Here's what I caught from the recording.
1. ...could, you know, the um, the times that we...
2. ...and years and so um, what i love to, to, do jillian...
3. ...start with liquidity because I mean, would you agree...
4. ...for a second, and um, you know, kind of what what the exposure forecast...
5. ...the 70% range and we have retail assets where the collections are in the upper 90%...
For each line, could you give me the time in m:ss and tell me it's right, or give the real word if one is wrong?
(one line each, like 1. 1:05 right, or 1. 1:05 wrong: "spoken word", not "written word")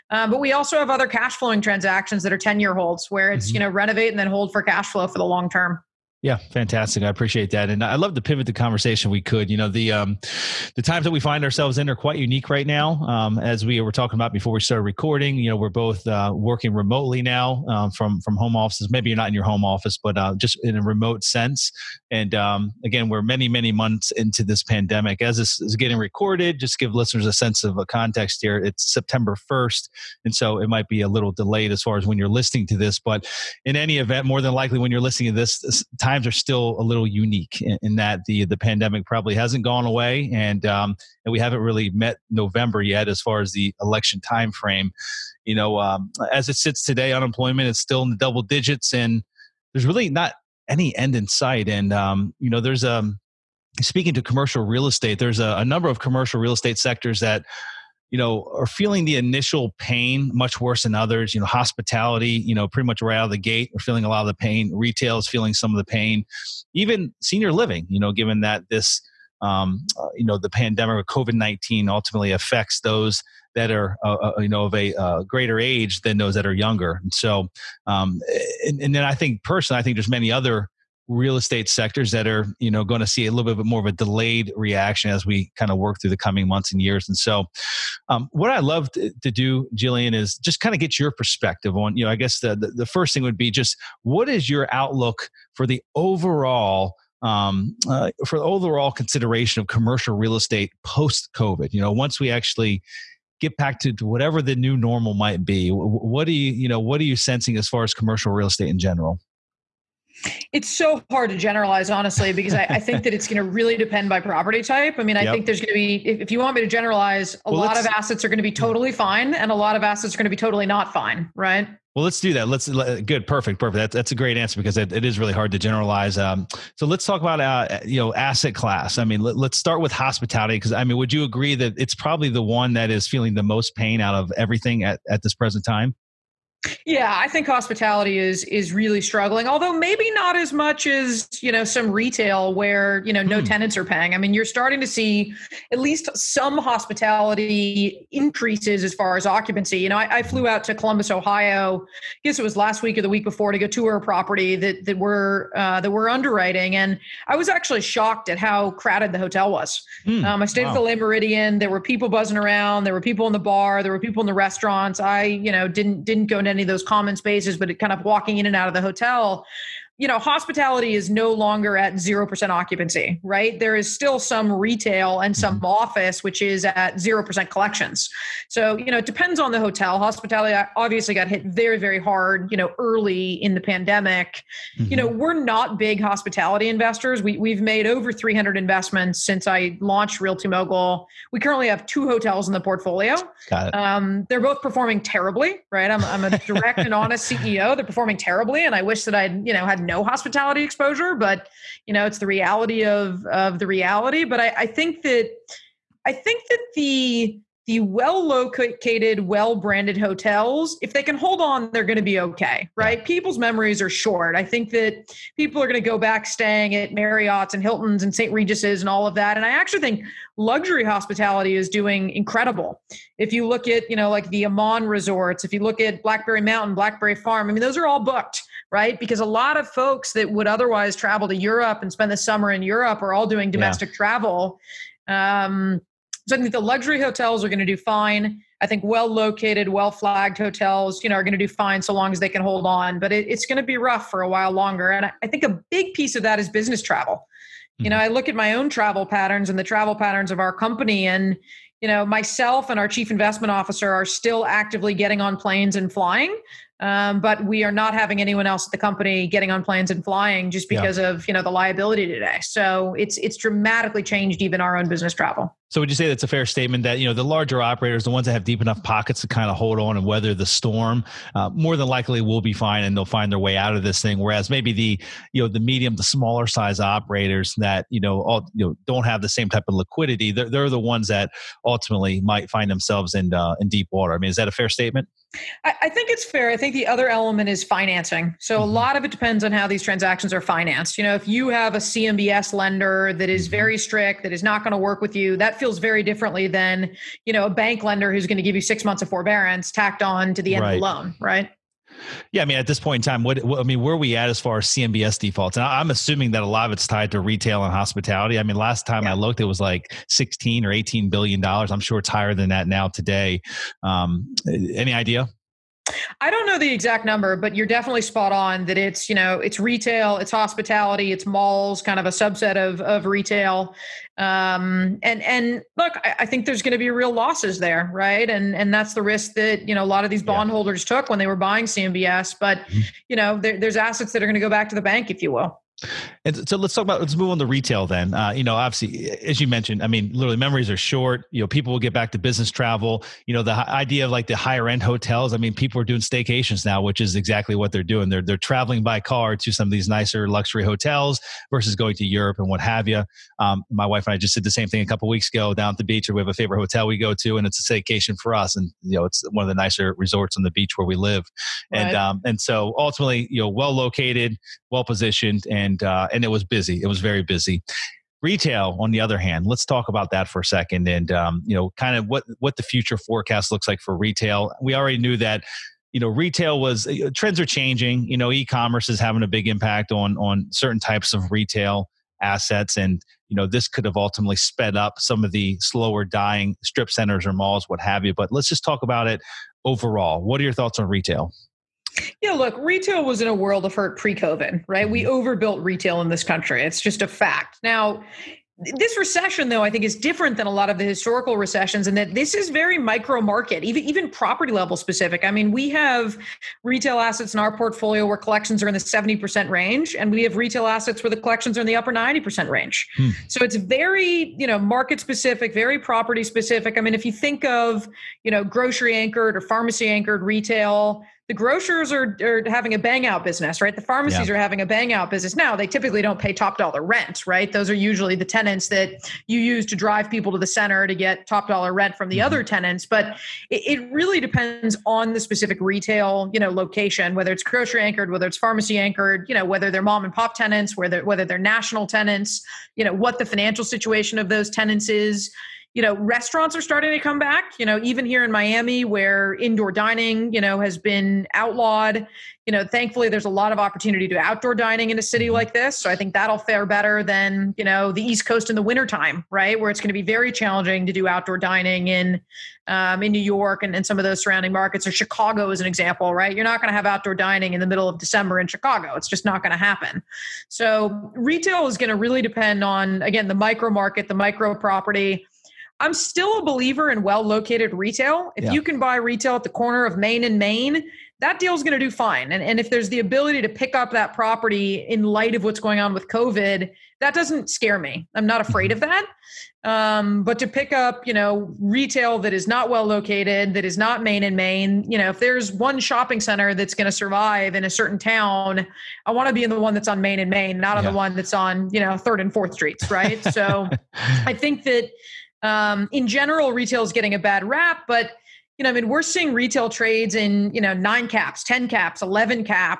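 1. 0:09 right
2. 1:26 right
3. 2:09 wrong: "hospitality", not "liquidity"
4. 6:10 wrong: "future", not "exposure"
5. 6:48 right.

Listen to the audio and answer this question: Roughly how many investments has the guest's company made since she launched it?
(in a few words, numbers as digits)
over 300.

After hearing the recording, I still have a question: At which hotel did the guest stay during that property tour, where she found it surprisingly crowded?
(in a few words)
Le Méridien.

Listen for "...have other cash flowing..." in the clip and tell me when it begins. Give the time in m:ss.
0:00.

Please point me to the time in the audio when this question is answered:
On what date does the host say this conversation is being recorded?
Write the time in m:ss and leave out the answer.
0:28.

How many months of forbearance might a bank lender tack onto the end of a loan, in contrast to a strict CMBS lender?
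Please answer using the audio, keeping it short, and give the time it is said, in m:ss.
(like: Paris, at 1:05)
6 months, at 4:58.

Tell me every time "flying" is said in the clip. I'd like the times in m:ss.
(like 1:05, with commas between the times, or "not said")
4:15, 4:20.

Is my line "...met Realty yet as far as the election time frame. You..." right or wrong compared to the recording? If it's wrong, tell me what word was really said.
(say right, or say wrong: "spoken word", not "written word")
wrong: "November", not "Realty".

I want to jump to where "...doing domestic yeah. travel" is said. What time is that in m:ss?
3:53.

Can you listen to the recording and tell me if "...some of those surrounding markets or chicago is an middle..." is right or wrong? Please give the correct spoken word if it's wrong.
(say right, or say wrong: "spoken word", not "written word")
wrong: "example", not "middle".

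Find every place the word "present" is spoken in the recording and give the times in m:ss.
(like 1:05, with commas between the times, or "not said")
2:15.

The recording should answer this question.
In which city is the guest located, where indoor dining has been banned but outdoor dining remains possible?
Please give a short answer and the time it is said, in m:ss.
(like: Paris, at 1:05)
Miami, at 7:28.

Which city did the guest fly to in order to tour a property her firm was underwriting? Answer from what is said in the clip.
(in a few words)
Columbus, Ohio.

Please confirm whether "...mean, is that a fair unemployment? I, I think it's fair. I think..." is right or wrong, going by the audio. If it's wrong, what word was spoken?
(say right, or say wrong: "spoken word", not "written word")
wrong: "statement", not "unemployment".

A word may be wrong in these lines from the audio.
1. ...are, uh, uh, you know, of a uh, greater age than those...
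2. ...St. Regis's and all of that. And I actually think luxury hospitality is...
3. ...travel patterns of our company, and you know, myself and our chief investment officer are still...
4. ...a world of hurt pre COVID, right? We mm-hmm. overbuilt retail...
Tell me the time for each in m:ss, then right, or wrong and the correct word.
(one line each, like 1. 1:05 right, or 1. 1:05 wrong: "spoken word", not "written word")
1. 1:13 right
2. 3:38 right
3. 4:09 right
4. 6:33 right.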